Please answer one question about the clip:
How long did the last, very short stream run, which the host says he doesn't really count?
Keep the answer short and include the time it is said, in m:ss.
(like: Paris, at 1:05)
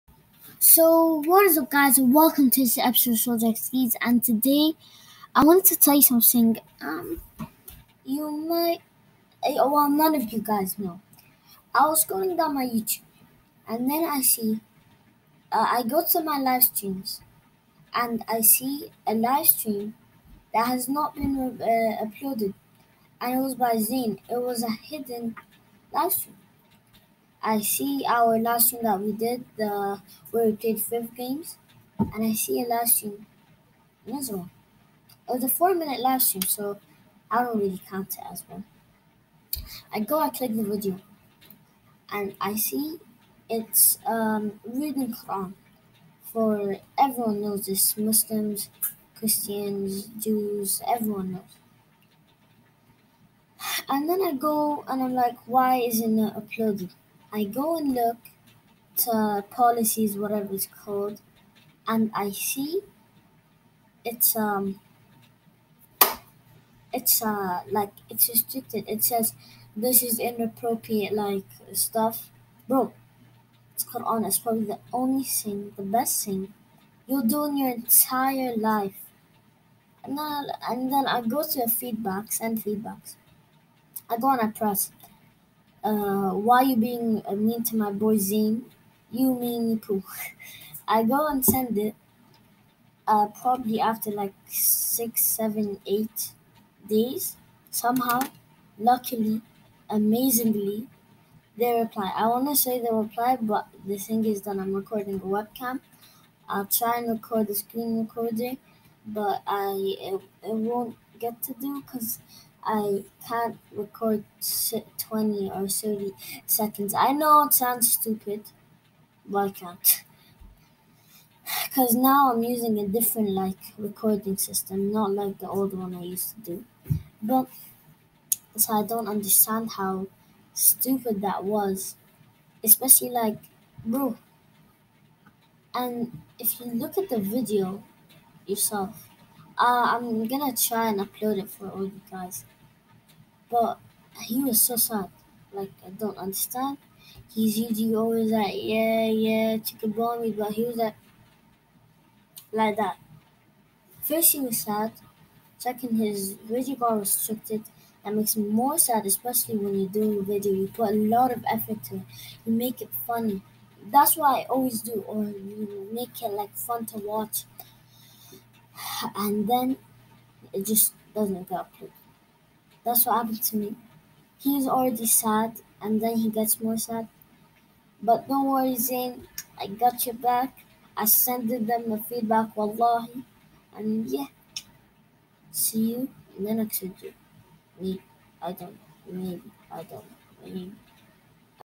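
4 minutes, at 0:35.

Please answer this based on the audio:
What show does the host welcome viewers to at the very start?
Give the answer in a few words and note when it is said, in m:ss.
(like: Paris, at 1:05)
Project Skis, at 0:03.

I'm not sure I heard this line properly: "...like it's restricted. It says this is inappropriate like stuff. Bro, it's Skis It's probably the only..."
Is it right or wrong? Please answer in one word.
wrong.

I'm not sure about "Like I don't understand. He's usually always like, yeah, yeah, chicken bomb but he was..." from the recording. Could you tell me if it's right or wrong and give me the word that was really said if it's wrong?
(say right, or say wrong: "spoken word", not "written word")
right.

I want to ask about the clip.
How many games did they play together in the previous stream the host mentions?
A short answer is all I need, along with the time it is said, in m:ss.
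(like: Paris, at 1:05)
5, at 0:30.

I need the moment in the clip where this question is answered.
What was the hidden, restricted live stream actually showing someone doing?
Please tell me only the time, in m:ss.
0:44.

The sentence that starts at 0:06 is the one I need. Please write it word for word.
Um, you might, eh, well, none of you guys know.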